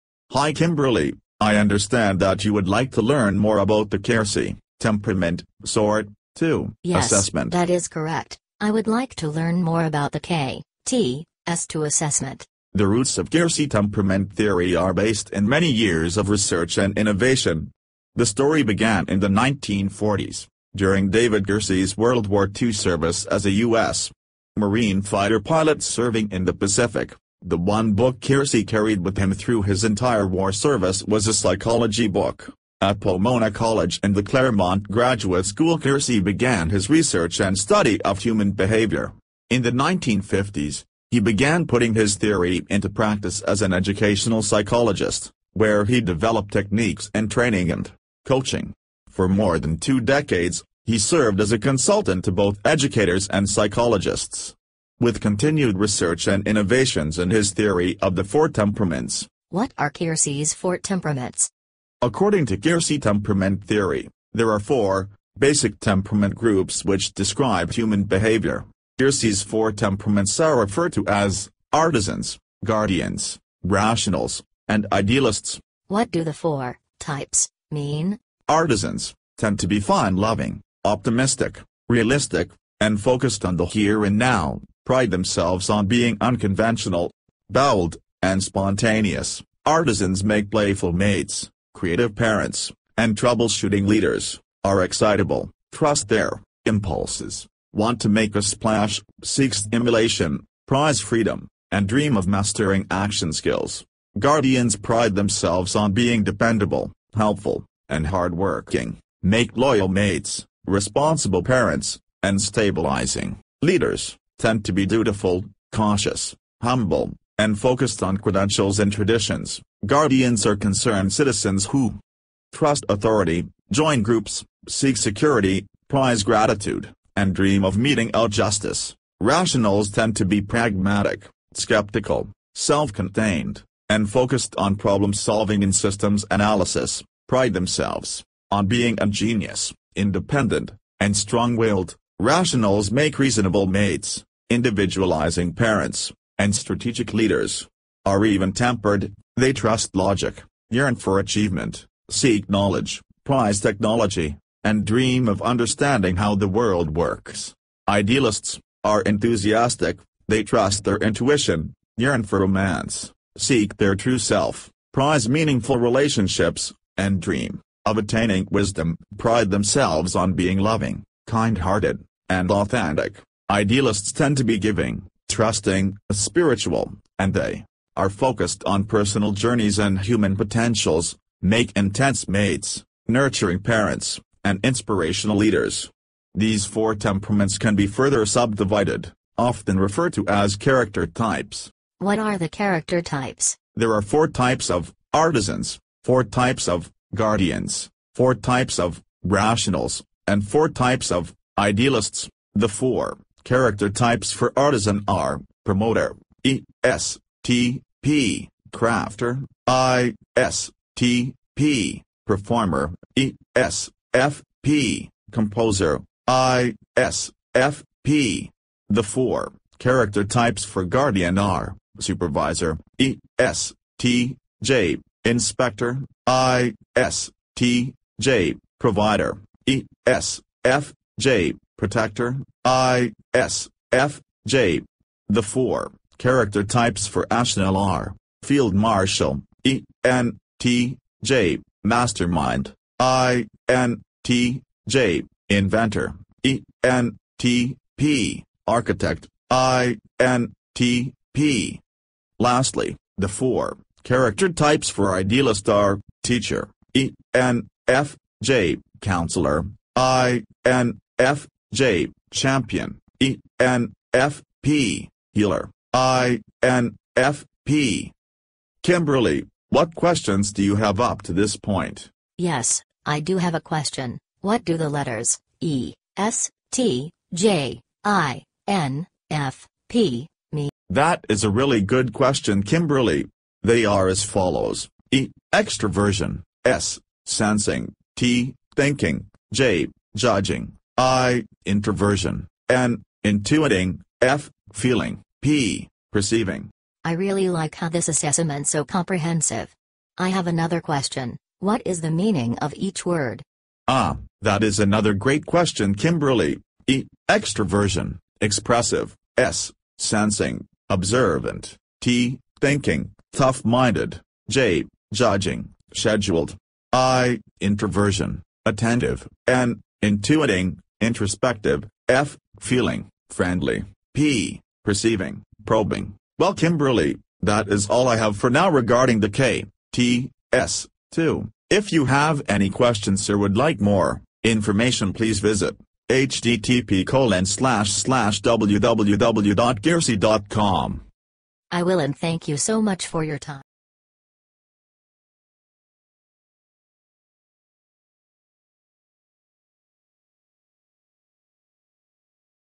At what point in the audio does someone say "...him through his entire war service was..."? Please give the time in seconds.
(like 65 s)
29 s.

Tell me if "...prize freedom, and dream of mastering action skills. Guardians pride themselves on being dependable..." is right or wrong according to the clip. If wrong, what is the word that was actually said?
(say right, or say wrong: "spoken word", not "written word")
right.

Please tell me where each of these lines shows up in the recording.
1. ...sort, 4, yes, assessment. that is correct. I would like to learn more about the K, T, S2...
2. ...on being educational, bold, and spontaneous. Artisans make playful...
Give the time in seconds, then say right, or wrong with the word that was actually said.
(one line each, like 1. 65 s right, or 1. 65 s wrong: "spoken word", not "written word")
1. 5 s wrong: "2", not "4"
2. 85 s wrong: "unconventional", not "educational".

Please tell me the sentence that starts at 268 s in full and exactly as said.
Kimberly, what questions do you have up to this point?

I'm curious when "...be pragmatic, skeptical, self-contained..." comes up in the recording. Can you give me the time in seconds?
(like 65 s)
130 s.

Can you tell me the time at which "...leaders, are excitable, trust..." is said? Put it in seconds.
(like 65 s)
93 s.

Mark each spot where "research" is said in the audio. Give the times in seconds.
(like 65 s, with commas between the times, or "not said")
16 s, 36 s, 55 s.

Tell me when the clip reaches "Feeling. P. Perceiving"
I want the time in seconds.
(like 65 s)
294 s.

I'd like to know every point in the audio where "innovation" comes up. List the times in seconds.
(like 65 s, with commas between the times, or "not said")
16 s, 56 s.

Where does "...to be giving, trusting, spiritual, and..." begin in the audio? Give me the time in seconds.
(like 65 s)
174 s.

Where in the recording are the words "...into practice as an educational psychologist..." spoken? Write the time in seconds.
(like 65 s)
42 s.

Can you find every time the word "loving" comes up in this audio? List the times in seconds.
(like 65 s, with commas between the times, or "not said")
79 s, 170 s.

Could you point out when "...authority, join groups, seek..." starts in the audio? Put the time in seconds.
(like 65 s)
122 s.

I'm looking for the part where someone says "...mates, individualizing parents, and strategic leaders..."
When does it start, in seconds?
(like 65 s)
143 s.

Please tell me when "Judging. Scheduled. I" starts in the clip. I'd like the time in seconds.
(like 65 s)
315 s.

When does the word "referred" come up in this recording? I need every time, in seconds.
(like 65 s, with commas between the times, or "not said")
70 s, 189 s.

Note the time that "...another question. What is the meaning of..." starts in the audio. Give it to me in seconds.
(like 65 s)
300 s.